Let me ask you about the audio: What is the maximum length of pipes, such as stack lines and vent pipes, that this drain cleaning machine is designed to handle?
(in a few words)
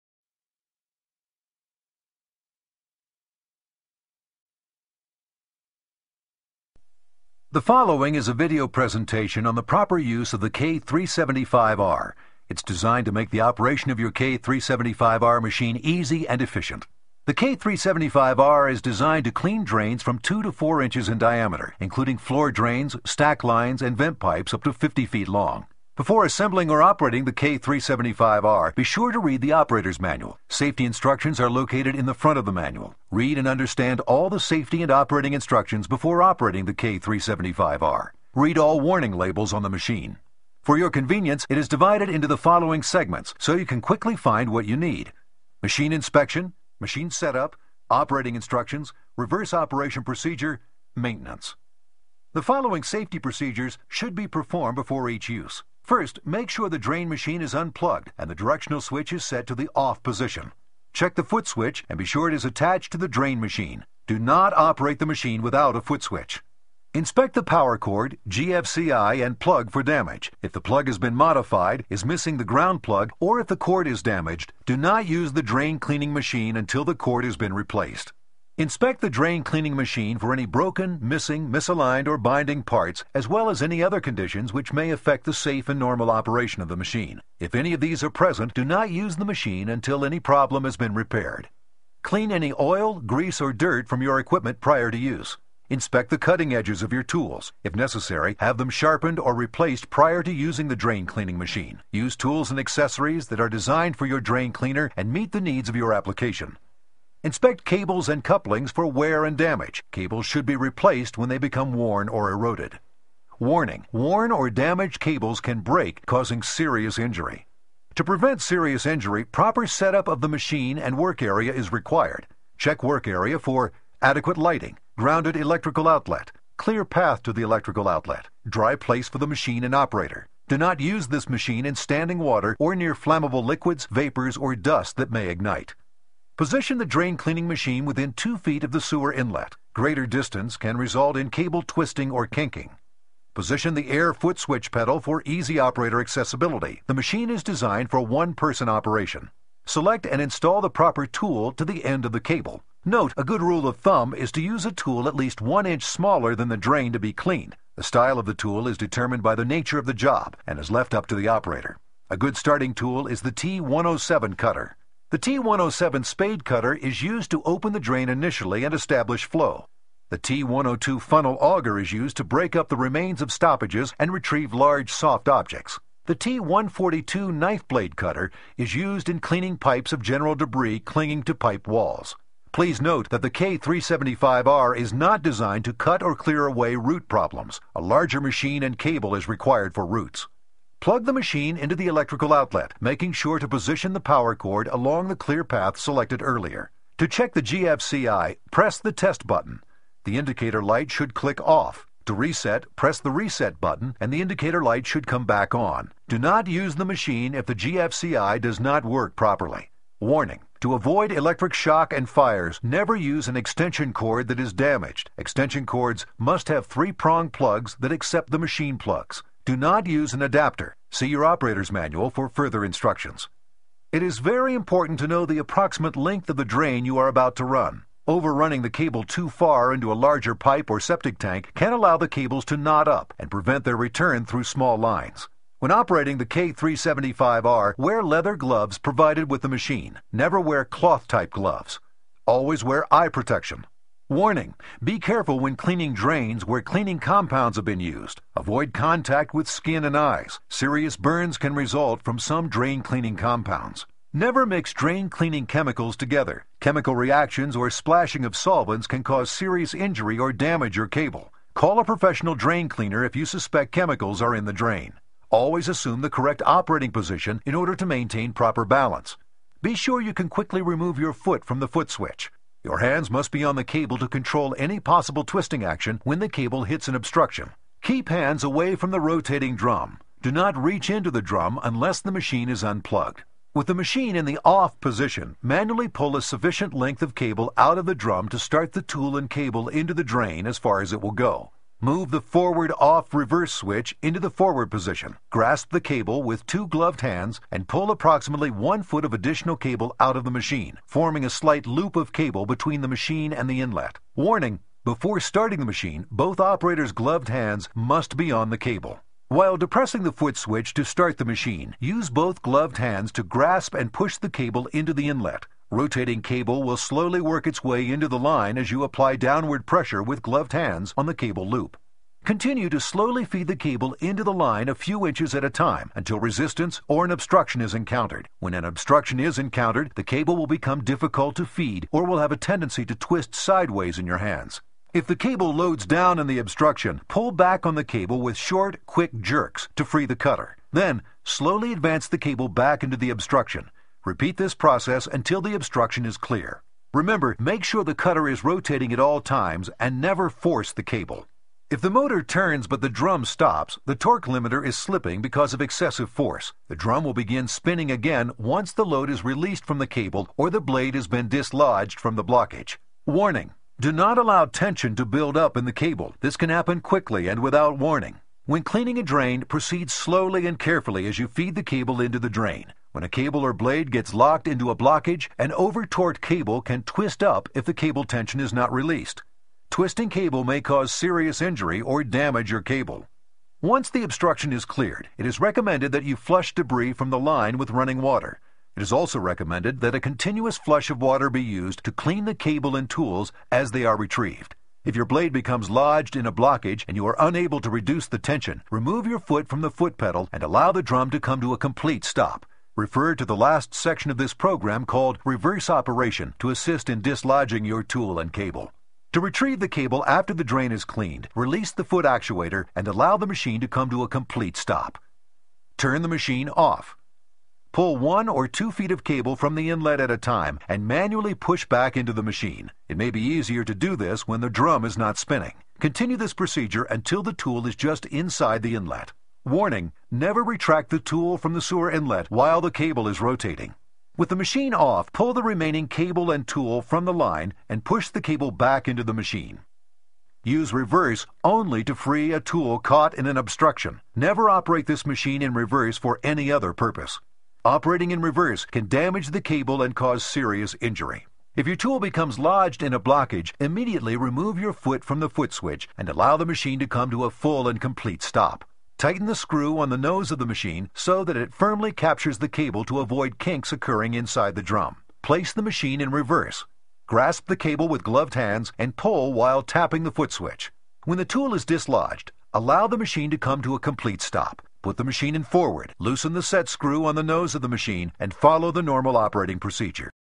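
50 feet.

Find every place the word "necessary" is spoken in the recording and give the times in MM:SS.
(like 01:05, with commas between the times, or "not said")
01:37.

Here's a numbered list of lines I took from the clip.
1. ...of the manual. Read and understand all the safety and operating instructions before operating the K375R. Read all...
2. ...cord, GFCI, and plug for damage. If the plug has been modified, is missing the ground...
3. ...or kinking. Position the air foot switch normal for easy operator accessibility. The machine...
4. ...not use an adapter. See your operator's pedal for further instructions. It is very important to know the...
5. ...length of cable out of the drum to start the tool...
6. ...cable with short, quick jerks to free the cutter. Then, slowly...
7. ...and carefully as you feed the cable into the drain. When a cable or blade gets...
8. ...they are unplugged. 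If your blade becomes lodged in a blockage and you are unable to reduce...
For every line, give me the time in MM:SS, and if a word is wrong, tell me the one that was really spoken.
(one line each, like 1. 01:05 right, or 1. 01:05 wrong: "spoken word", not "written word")
1. 00:32 right
2. 01:07 right
3. 02:22 wrong: "pedal", not "normal"
4. 03:39 wrong: "manual", not "pedal"
5. 04:46 right
6. 05:37 right
7. 06:10 right
8. 06:33 wrong: "retrieved", not "unplugged".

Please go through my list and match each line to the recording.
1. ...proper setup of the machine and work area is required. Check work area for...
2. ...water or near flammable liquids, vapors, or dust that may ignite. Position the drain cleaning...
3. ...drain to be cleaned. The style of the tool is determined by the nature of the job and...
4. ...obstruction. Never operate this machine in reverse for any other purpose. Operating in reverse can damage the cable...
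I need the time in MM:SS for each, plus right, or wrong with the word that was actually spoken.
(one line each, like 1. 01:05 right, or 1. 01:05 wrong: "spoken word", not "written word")
1. 01:59 right
2. 02:12 right
3. 02:36 right
4. 07:23 right.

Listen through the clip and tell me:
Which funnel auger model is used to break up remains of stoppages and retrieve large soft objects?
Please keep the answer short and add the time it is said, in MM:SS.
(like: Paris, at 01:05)
T-102, at 02:50.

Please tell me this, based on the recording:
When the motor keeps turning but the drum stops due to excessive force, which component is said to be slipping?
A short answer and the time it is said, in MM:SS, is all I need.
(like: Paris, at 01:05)
torque limiter, at 05:53.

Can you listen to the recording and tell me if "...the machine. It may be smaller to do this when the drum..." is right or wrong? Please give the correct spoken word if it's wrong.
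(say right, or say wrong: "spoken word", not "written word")
wrong: "easier", not "smaller".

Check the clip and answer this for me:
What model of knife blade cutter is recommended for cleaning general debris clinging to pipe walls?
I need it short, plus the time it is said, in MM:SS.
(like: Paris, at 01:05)
T-142, at 02:56.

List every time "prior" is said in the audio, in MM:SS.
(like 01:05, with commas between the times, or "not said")
01:34, 01:39.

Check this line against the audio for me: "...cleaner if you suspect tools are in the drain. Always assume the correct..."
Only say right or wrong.
wrong.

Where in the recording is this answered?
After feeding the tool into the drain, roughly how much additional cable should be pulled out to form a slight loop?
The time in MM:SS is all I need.
04:58.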